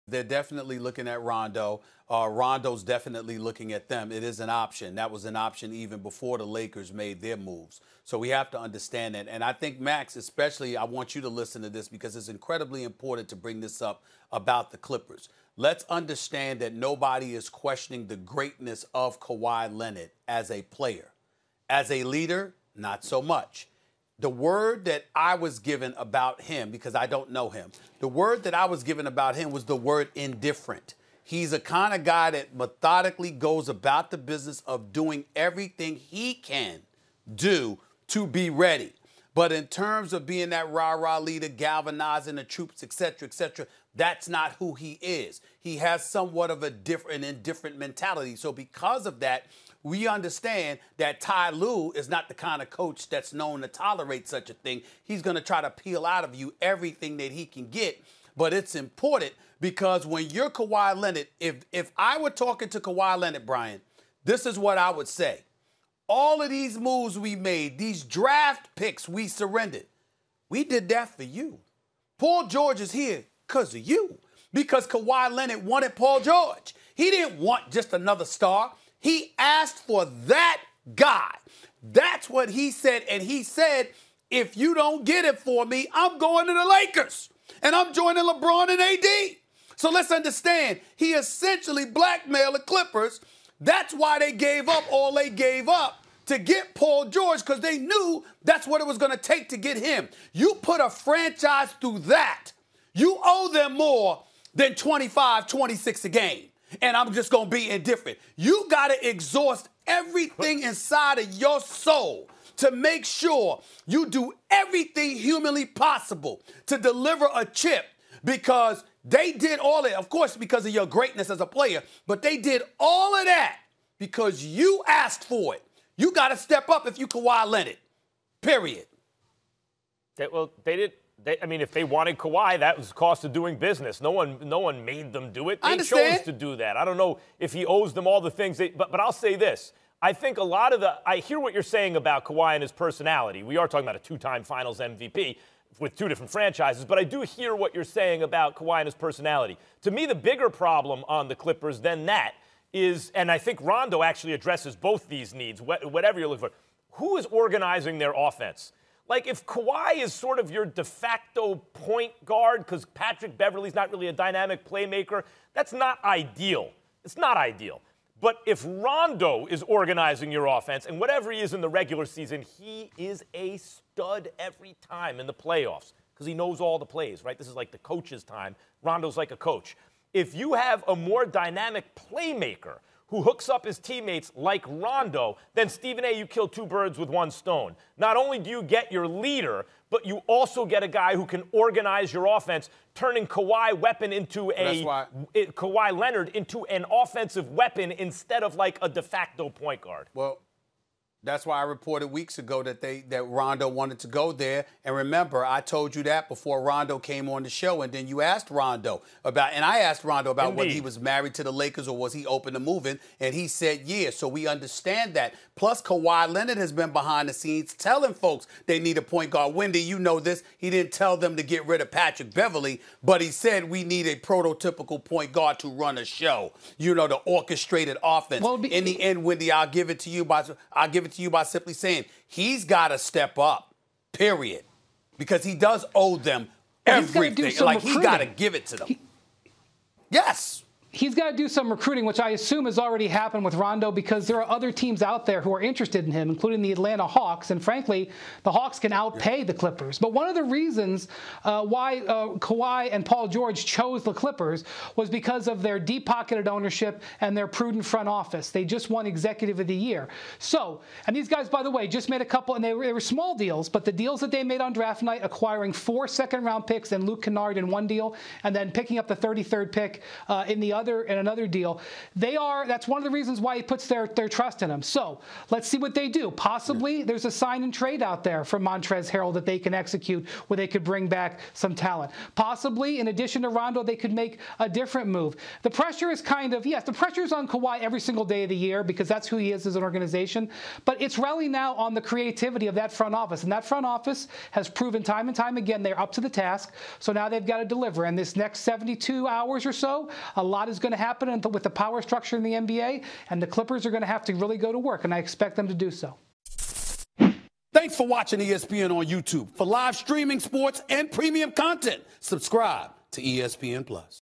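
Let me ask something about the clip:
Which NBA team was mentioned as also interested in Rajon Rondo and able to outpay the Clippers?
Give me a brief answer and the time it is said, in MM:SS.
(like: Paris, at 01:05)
Atlanta Hawks, at 04:06.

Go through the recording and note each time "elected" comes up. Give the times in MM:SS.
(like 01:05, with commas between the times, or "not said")
not said.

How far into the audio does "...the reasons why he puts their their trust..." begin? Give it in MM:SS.
04:33.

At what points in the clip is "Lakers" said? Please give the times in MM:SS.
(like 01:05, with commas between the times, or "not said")
00:06, 01:26, 03:31.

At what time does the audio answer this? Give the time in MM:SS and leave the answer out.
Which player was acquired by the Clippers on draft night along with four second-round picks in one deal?
04:27.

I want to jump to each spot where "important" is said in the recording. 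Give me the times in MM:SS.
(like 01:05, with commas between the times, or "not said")
00:12, 00:58.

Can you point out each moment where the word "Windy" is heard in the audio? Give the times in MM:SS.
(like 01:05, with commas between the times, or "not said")
03:39, 03:49.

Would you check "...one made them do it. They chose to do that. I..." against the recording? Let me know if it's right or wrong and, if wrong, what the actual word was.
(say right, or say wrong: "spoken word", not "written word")
right.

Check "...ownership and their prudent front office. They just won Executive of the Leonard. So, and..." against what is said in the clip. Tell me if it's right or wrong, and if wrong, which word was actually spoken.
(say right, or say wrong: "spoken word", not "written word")
wrong: "Year", not "Leonard".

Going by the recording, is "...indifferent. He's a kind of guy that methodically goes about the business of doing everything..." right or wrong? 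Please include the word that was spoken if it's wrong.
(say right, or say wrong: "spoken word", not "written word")
right.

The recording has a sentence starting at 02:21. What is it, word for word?
I hear what you're saying about Kawhi and his personality.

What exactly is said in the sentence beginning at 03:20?
Well, that's why I reported weeks ago that they that Rondo wanted to go there.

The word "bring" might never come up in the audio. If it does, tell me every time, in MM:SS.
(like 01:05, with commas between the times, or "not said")
00:13, 04:40.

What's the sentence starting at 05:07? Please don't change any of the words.
Thanks for watching ESPN on YouTube.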